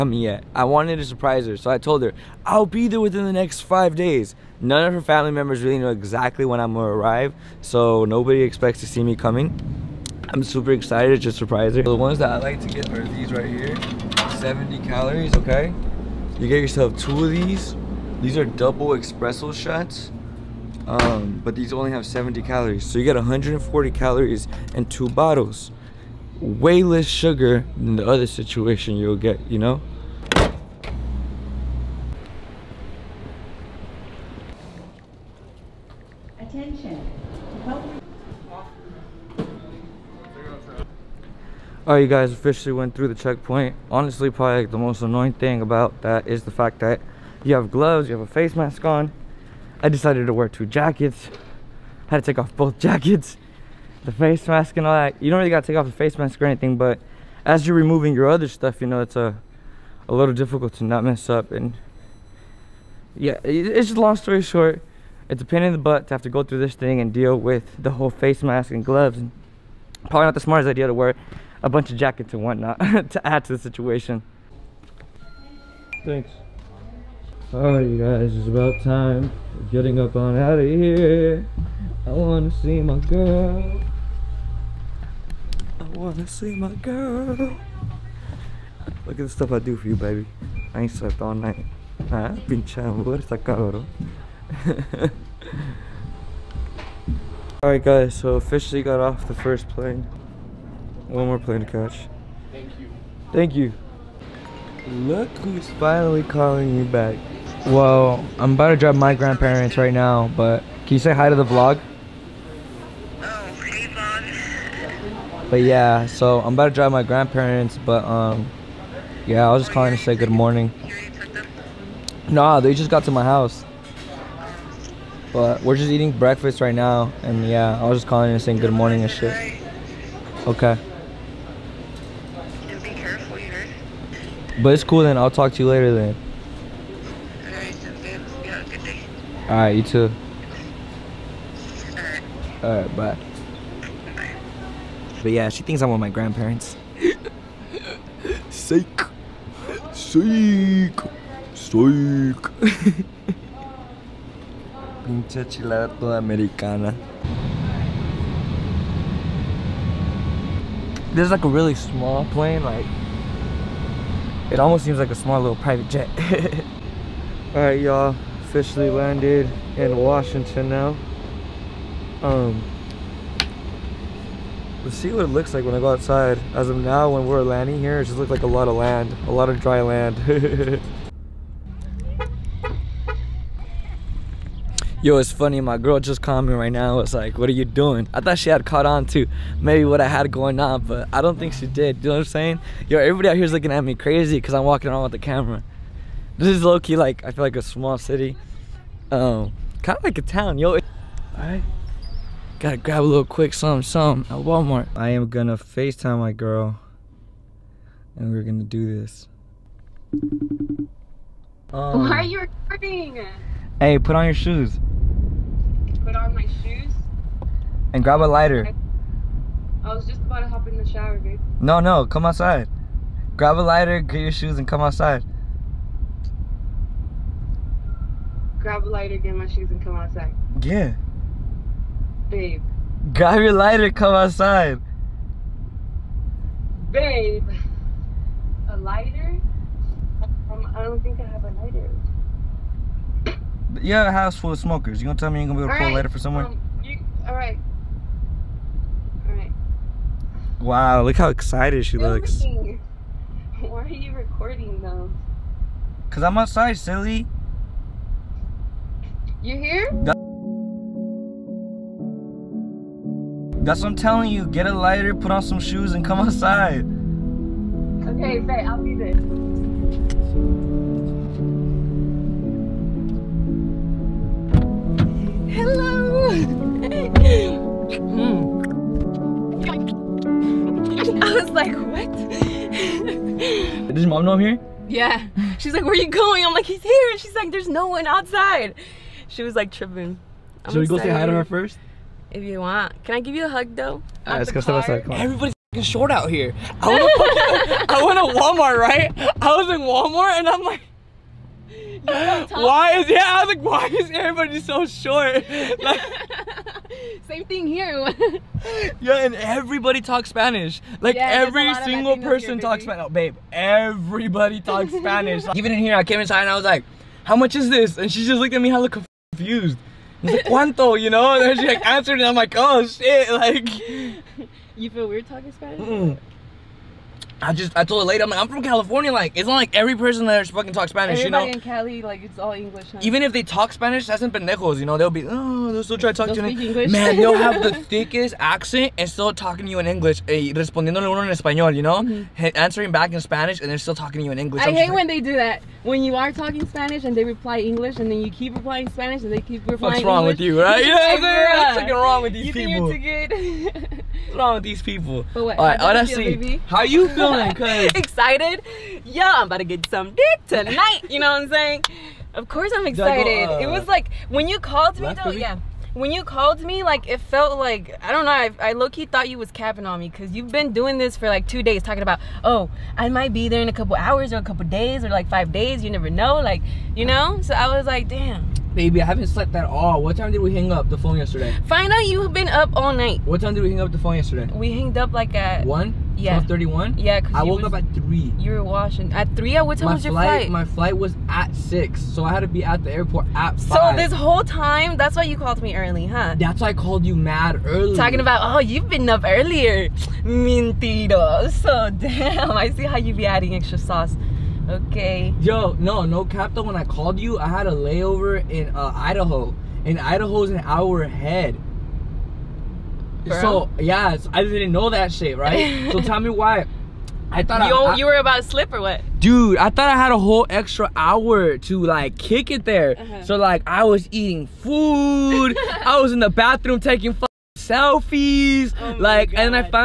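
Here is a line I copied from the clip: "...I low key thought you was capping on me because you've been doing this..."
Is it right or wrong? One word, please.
right.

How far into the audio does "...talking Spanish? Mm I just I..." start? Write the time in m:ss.
5:25.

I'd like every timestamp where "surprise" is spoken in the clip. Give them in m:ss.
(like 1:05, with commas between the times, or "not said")
0:01, 0:11.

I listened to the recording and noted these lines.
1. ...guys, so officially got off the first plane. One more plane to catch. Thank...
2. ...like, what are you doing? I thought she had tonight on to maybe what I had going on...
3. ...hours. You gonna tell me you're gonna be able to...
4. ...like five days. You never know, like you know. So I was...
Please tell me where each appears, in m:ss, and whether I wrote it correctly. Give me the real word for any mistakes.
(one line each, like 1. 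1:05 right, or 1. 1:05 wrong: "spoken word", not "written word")
1. 1:37 right
2. 3:07 wrong: "caught", not "tonight"
3. 4:04 wrong: "smokers", not "hours"
4. 6:15 right.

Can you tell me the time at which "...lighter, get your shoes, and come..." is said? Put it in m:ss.
3:43.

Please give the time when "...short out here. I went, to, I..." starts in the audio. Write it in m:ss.
4:55.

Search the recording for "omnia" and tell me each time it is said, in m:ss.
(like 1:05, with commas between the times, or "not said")
not said.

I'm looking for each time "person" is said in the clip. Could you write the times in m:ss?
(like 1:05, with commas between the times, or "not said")
5:12, 5:29.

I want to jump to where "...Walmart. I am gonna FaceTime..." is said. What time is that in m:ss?
3:24.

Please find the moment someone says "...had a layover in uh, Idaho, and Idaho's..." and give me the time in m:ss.
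6:47.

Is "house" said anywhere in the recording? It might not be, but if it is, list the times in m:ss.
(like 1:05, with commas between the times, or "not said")
2:03, 4:04.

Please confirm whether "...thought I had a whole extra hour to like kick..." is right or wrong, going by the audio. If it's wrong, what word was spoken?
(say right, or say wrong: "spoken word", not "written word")
right.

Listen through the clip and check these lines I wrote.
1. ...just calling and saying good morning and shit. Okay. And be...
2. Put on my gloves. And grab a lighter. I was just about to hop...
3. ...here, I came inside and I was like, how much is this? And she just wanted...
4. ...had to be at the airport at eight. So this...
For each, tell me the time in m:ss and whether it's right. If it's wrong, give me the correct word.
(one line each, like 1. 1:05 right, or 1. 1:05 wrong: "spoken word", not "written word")
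1. 2:07 right
2. 3:36 wrong: "shoes", not "gloves"
3. 5:15 wrong: "looked", not "wanted"
4. 6:32 wrong: "five", not "eight".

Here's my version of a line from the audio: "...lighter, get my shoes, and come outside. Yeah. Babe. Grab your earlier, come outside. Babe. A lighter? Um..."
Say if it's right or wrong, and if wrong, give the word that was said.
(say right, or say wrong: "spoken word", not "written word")
wrong: "lighter", not "earlier".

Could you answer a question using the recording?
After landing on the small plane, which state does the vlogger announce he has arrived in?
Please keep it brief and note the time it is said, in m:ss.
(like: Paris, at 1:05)
Washington, at 2:49.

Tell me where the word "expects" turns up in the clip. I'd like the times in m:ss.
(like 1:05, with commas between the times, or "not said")
0:08.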